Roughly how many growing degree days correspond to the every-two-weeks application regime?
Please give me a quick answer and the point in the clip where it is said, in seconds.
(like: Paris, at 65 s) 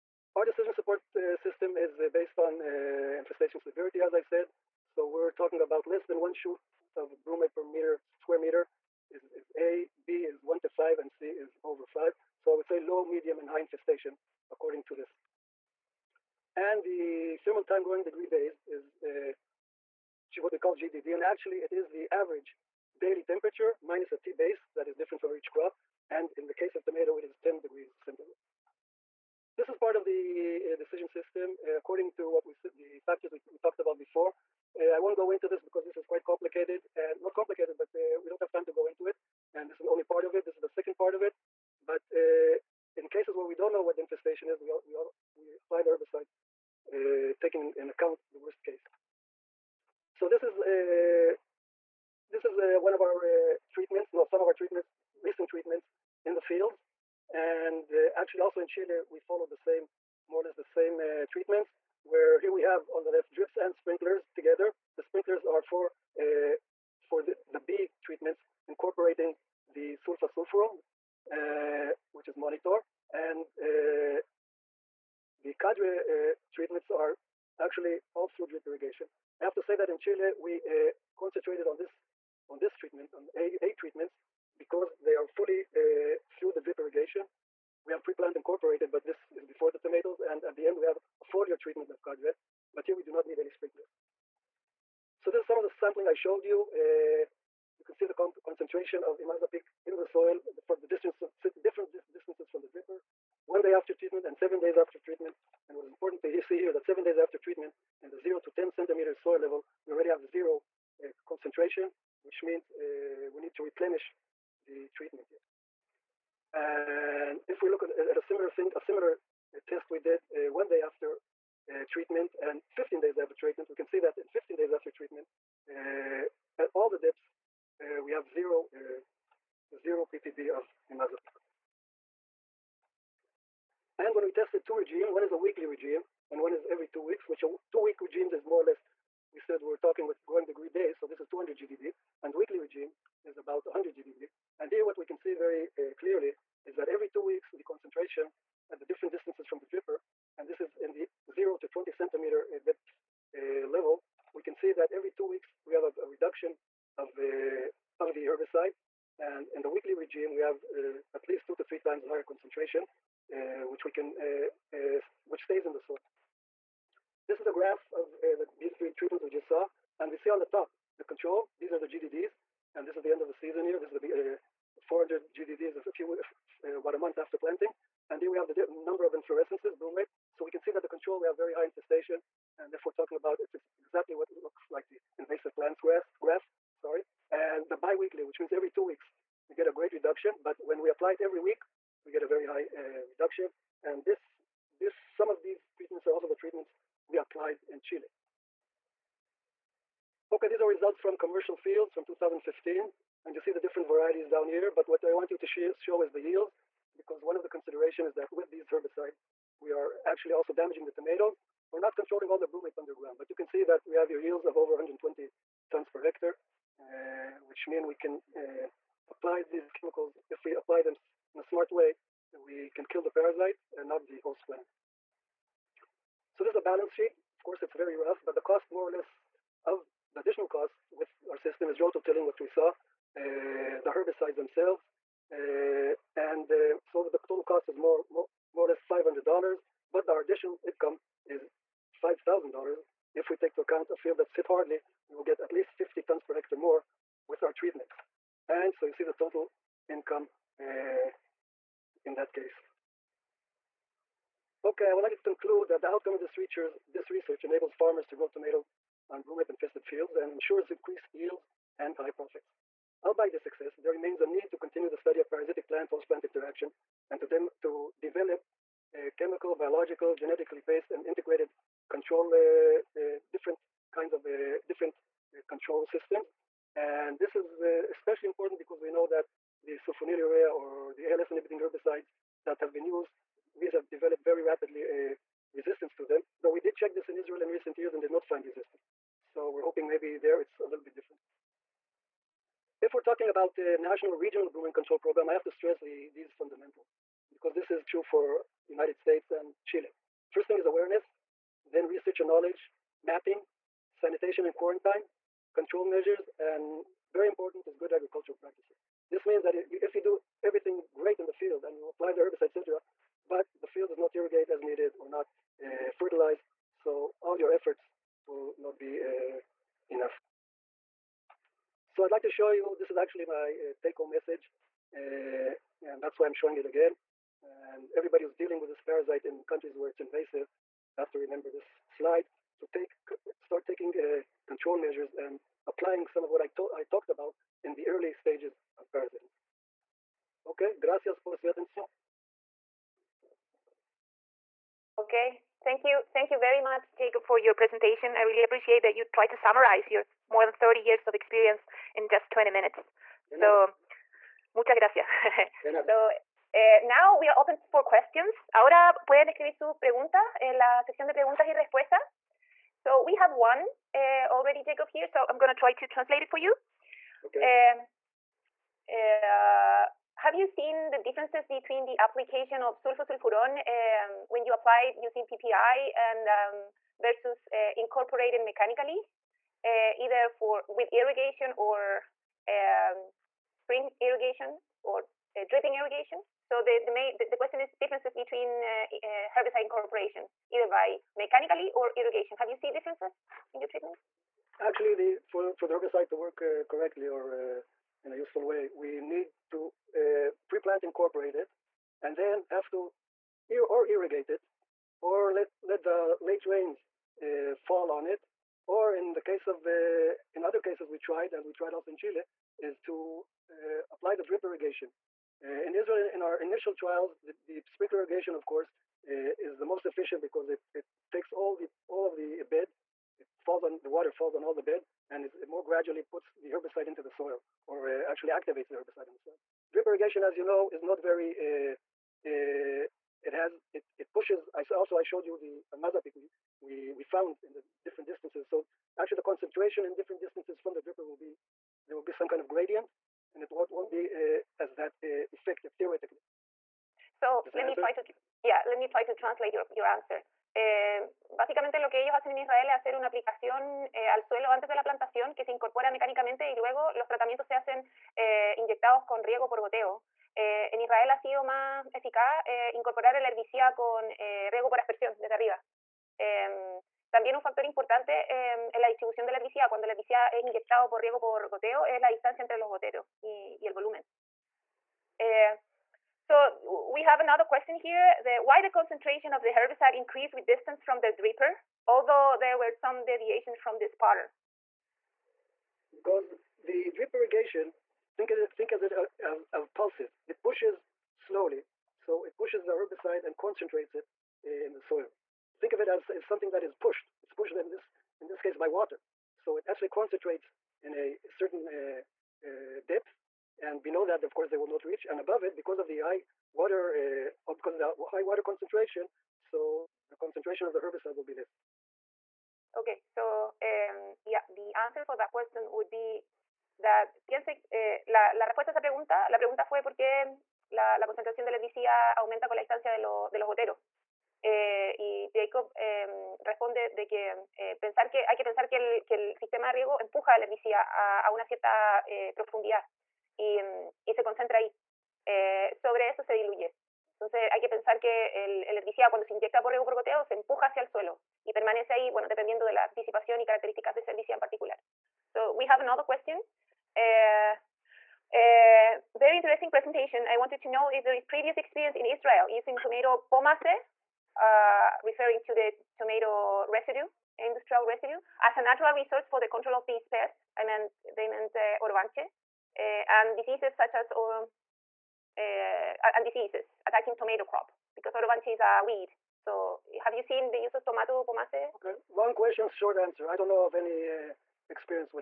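200 GDD, at 141 s.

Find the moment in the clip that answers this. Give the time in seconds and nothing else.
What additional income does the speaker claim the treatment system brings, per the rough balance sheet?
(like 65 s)
242 s.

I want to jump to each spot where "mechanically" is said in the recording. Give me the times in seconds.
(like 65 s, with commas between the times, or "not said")
378 s, 391 s.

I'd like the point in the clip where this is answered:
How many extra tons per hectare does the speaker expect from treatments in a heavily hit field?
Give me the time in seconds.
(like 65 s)
245 s.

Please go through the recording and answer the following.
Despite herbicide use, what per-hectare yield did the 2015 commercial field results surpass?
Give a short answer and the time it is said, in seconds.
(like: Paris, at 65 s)
120 tons, at 214 s.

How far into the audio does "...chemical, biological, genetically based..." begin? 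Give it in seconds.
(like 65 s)
269 s.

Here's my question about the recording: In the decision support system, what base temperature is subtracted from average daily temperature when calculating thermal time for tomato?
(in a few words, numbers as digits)
10 degrees centigrade.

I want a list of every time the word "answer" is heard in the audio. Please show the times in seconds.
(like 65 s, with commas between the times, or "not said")
449 s, 572 s.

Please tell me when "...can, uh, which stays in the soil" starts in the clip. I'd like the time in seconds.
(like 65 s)
163 s.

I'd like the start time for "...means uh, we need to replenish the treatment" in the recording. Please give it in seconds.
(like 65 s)
112 s.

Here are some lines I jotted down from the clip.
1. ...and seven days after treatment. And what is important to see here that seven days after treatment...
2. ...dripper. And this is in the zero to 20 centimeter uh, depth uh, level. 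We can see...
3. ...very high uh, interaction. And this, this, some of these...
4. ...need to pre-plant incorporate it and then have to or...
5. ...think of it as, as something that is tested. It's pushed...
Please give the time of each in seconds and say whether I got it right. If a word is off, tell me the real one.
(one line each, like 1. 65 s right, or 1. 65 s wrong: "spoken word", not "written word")
1. 104 s right
2. 149 s right
3. 192 s wrong: "reduction", not "interaction"
4. 398 s right
5. 495 s wrong: "pushed", not "tested".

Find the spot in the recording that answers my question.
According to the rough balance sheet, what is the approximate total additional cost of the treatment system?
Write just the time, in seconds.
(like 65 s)
238 s.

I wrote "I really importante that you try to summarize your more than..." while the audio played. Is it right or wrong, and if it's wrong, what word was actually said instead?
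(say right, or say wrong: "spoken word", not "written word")
wrong: "appreciate", not "importante".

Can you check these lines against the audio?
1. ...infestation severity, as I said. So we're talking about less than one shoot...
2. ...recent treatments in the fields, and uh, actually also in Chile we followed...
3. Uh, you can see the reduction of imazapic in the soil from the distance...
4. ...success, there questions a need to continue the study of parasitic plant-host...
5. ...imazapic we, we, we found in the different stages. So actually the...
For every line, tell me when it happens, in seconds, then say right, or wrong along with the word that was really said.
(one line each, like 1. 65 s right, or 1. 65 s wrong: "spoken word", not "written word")
1. 3 s right
2. 55 s right
3. 96 s wrong: "concentration", not "reduction"
4. 263 s wrong: "remains", not "questions"
5. 435 s wrong: "distances", not "stages".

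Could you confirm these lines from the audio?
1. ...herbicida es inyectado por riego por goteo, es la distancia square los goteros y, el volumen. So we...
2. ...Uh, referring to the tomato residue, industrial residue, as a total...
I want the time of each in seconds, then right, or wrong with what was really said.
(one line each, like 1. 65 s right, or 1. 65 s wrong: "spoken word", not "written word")
1. 469 s wrong: "entre", not "square"
2. 554 s wrong: "natural", not "total".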